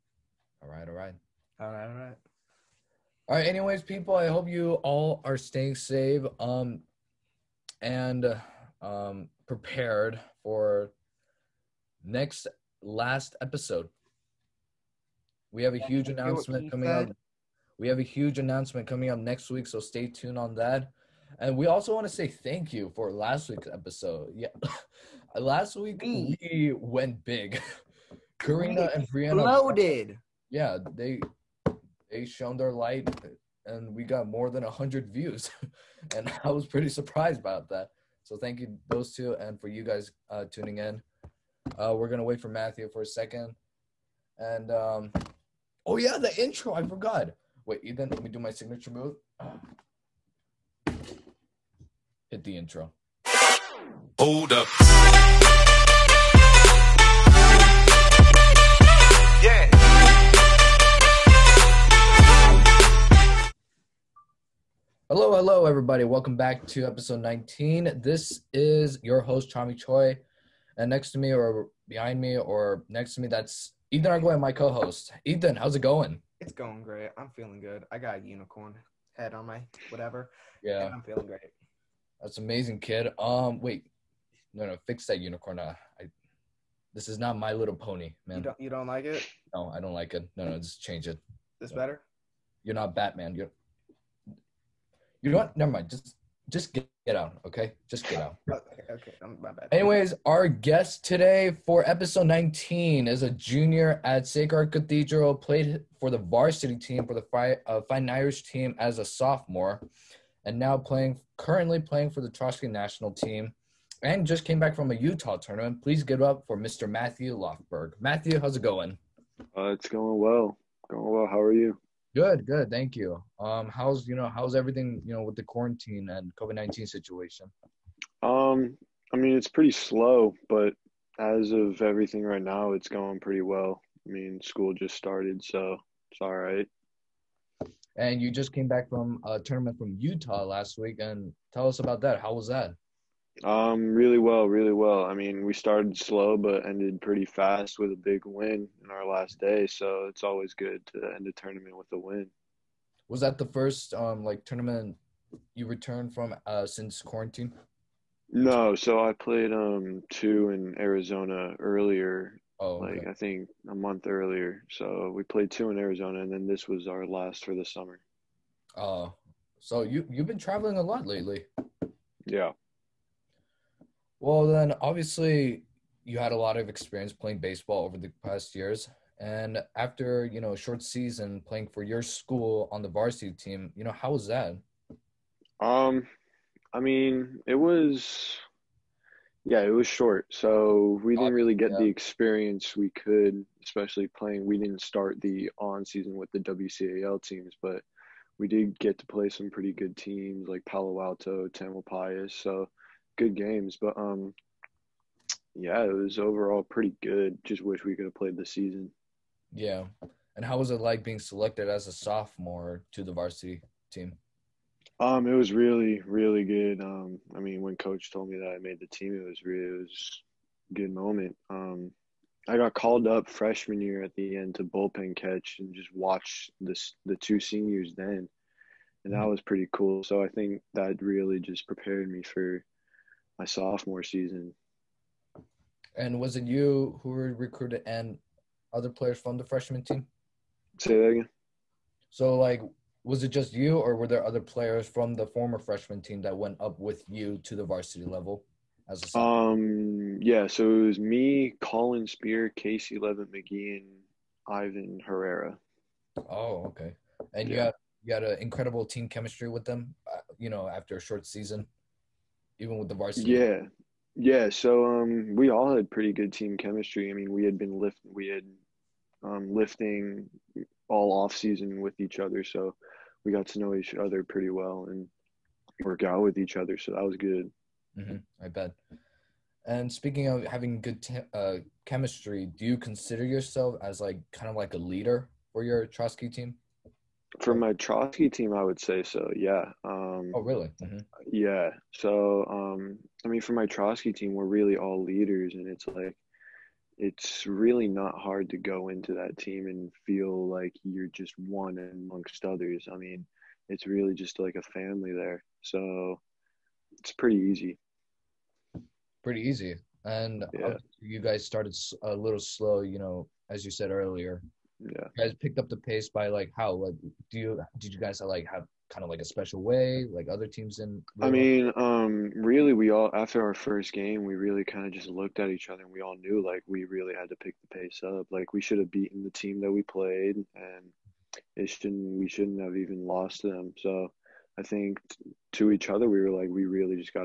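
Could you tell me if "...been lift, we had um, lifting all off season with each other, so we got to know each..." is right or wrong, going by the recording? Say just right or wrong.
right.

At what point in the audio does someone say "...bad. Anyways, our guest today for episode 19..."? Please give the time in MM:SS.
01:39.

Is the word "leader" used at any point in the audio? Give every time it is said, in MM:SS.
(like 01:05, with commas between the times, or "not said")
04:44, 04:55.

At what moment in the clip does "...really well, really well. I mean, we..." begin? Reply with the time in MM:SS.
02:23.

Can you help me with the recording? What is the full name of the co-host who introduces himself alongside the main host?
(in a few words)
Ethan Arguello.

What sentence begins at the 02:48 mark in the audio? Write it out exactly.
Oh, uh, so you you've been traveling a lot lately.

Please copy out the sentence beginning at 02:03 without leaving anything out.
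Um, how's you know how's everything you know with the quarantine and COVID nineteen situation?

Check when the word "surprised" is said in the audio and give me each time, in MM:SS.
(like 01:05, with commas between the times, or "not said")
00:36.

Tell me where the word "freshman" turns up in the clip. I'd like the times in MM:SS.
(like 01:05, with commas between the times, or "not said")
03:43, 03:59, 04:05.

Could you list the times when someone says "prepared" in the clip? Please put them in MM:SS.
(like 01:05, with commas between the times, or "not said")
00:09, 03:51.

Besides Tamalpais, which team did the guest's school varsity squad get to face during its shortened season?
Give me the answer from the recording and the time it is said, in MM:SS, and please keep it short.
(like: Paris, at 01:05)
Palo Alto, at 03:20.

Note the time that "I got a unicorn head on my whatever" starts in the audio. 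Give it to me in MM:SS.
01:17.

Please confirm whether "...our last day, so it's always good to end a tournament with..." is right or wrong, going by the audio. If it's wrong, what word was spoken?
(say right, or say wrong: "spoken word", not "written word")
right.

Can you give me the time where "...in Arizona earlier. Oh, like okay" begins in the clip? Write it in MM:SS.
02:40.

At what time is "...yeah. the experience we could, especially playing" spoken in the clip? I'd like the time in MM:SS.
03:11.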